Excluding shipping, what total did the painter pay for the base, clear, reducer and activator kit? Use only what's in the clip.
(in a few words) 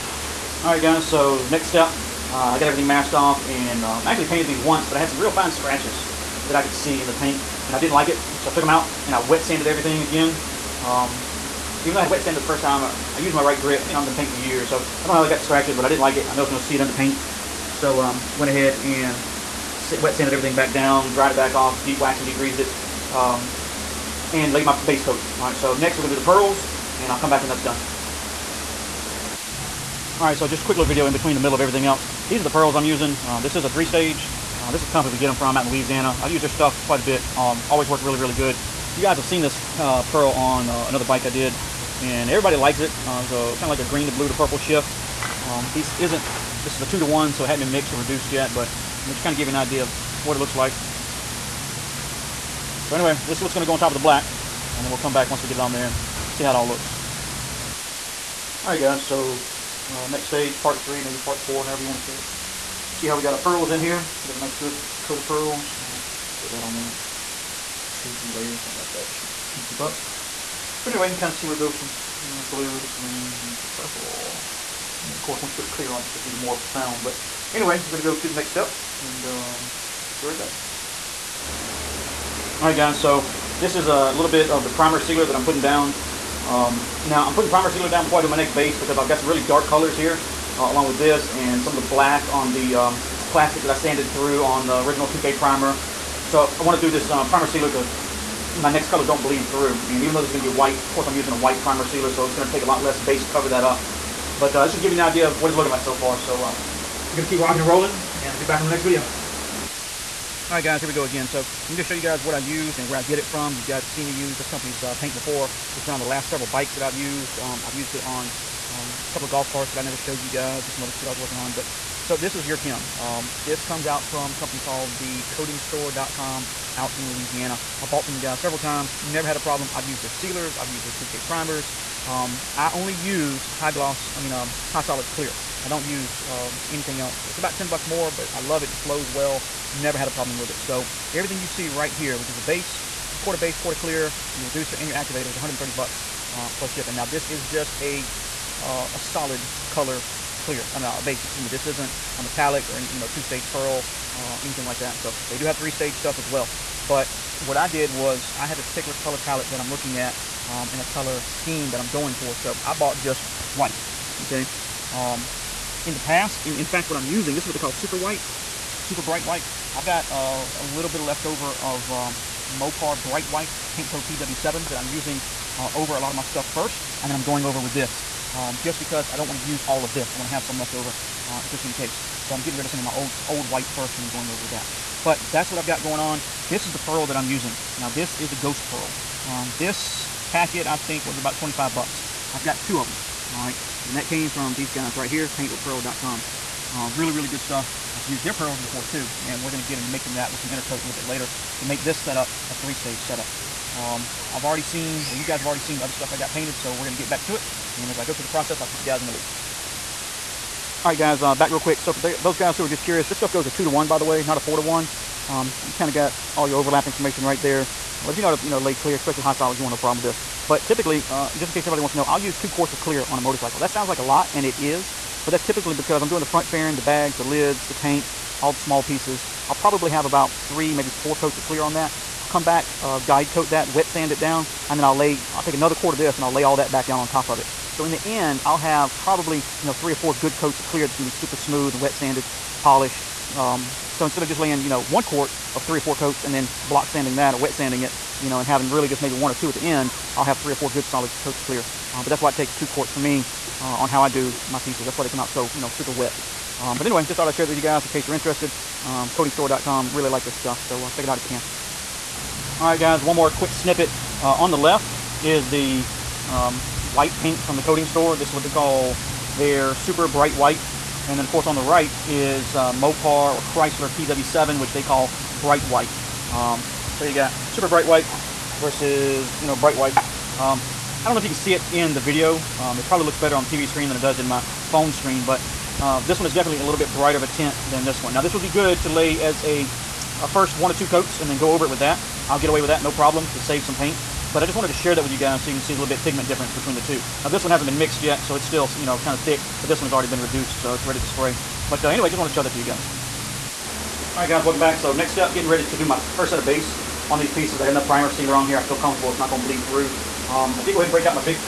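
$130.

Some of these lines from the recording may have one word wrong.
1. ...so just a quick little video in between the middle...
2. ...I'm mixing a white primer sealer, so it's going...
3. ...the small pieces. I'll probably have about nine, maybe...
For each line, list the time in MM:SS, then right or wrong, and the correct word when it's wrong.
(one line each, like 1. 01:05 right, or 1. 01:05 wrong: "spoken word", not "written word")
1. 00:30 right
2. 01:41 wrong: "using", not "mixing"
3. 03:48 wrong: "three", not "nine".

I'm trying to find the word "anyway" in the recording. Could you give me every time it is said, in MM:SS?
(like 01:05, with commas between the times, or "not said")
00:52, 01:10, 01:17, 04:16, 05:01.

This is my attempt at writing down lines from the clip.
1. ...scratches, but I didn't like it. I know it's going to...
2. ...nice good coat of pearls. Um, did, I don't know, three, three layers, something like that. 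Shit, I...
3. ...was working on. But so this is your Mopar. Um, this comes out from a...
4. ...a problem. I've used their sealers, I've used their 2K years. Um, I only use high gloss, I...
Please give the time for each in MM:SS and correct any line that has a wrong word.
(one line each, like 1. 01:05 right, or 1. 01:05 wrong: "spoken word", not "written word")
1. 00:15 right
2. 01:04 wrong: "two", not "three"
3. 02:01 wrong: "Kim", not "Mopar"
4. 02:09 wrong: "primers", not "years".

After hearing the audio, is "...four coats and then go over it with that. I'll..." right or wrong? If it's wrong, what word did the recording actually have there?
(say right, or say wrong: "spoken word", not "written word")
wrong: "two", not "four".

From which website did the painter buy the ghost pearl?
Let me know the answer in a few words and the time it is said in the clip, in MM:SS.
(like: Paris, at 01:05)
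paintwithpearl.com, at 03:15.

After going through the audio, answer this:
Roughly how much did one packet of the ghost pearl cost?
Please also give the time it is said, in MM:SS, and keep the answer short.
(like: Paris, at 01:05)
$25, at 03:11.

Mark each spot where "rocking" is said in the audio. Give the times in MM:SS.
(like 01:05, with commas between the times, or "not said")
01:47.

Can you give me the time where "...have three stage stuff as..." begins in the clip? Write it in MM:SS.
02:35.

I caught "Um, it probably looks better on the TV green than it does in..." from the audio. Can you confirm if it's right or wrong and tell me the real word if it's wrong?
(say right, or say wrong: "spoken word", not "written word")
wrong: "screen", not "green".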